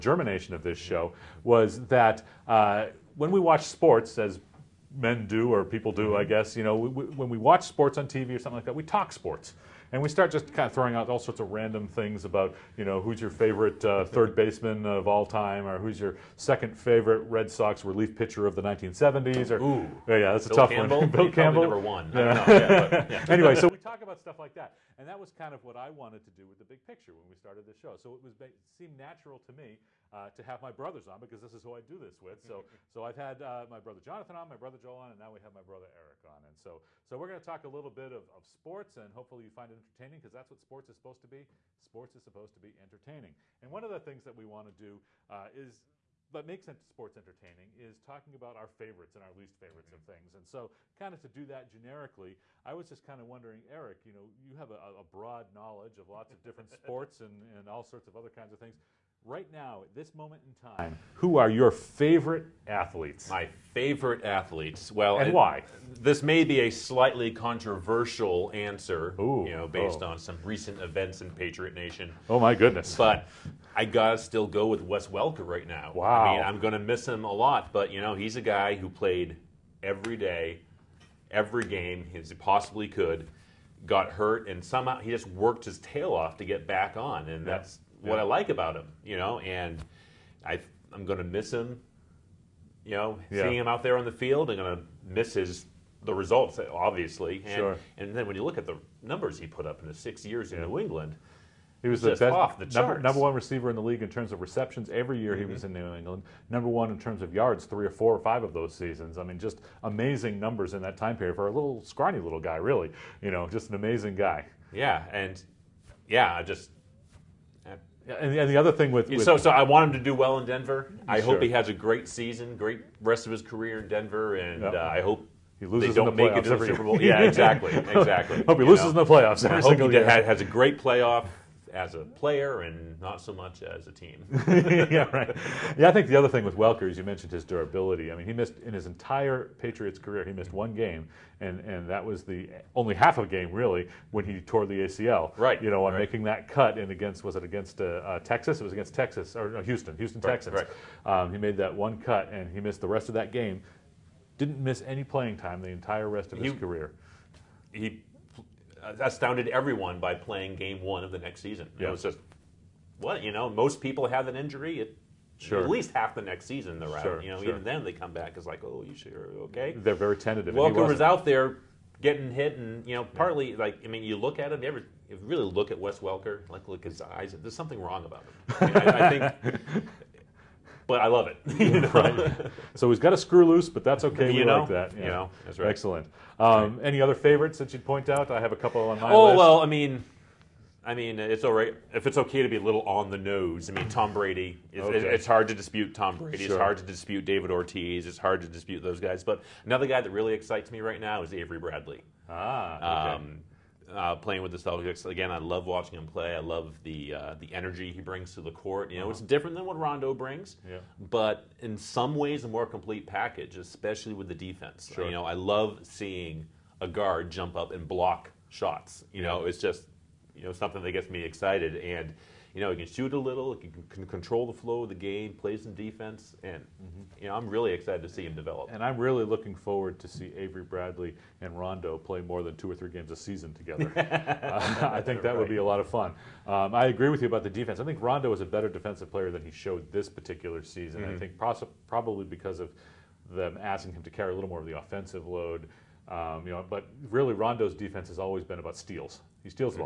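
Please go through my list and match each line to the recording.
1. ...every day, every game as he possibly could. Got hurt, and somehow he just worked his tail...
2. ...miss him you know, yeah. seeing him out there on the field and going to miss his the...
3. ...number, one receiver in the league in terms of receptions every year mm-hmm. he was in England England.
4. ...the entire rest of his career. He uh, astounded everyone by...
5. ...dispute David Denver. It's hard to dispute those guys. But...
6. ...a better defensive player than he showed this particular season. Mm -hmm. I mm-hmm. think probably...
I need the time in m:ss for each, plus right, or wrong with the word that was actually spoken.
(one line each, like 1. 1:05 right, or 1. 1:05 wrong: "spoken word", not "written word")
1. 1:19 right
2. 1:31 right
3. 1:42 wrong: "New", not "England"
4. 2:35 right
5. 3:16 wrong: "Ortiz", not "Denver"
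6. 3:58 right.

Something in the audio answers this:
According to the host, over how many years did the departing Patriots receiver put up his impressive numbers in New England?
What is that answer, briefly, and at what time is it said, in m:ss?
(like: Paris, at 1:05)
6, at 1:39.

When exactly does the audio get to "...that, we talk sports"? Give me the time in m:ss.
0:08.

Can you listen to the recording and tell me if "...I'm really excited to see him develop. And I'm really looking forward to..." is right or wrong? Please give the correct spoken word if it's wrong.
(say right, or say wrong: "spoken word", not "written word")
right.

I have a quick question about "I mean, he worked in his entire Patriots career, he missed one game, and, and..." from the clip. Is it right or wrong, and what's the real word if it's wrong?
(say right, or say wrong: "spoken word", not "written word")
wrong: "missed", not "worked".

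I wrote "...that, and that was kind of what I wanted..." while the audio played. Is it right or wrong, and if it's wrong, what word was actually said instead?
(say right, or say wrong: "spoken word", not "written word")
right.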